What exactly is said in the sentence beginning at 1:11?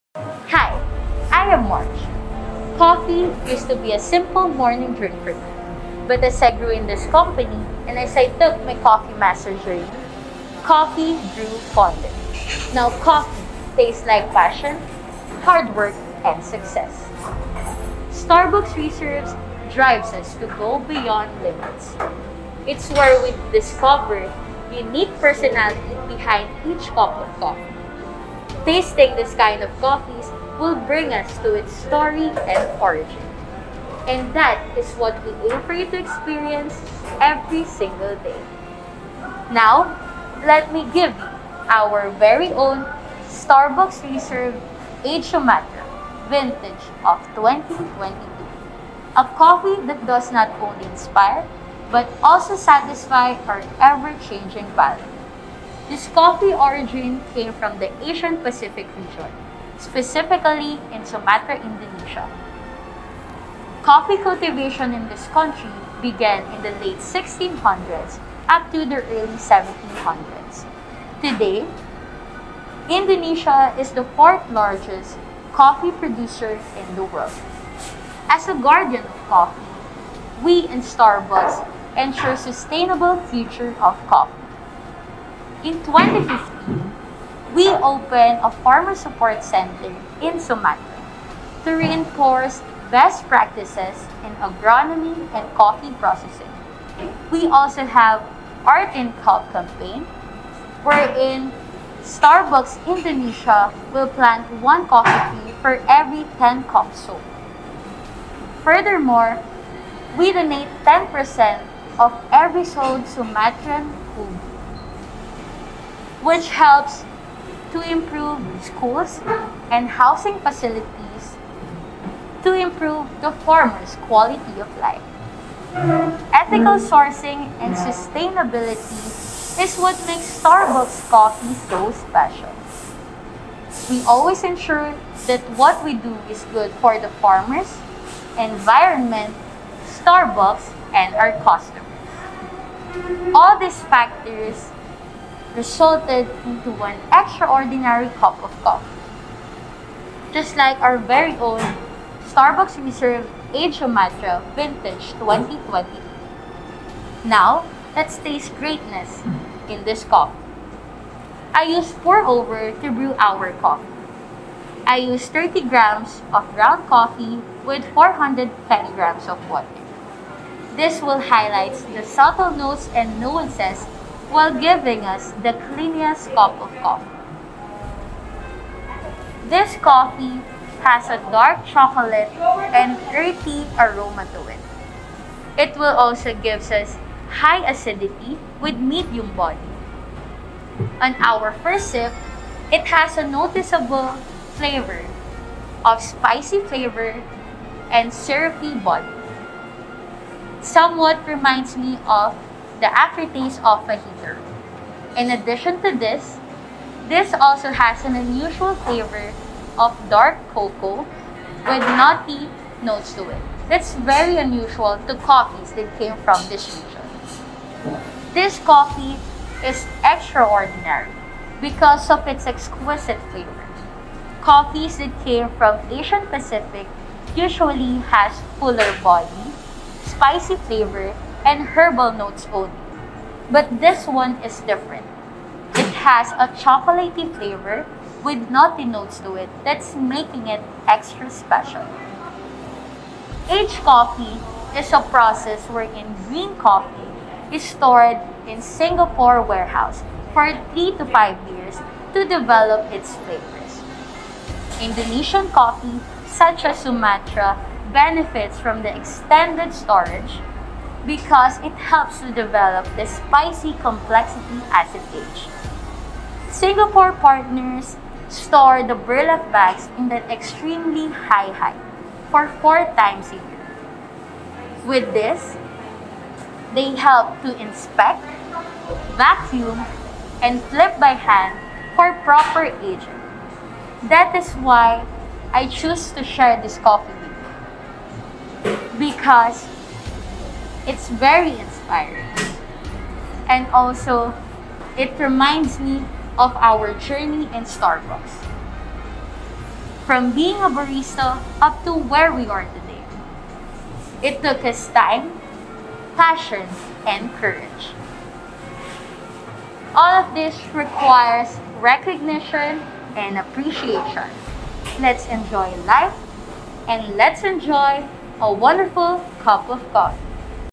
Today, Indonesia is the fourth largest coffee producer in the world.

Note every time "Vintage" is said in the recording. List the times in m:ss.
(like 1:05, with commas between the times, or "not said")
0:46, 2:34.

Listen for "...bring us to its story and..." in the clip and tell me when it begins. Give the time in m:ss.
0:30.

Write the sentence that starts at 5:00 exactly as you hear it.
From being a barista up to where we are today.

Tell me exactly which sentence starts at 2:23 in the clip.
All these factors resulted into an extraordinary cup of coffee.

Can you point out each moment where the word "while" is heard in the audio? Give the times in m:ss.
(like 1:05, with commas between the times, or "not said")
2:54.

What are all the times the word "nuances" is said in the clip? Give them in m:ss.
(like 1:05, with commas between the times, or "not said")
2:53.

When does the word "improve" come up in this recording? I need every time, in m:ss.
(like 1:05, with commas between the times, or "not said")
1:57, 2:02.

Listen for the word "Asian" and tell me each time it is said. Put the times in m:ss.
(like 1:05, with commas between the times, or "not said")
0:58, 3:45.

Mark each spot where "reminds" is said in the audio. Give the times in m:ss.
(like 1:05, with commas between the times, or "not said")
3:21, 4:55.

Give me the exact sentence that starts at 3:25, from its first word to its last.
In addition to this, this also has an unusual flavor of dark cocoa with nutty notes to it.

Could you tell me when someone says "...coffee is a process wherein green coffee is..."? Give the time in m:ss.
4:03.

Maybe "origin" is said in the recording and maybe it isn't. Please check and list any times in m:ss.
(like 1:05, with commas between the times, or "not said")
0:32, 0:56.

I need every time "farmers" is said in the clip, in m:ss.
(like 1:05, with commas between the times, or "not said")
1:28, 2:03, 2:17.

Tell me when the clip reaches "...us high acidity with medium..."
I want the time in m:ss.
3:06.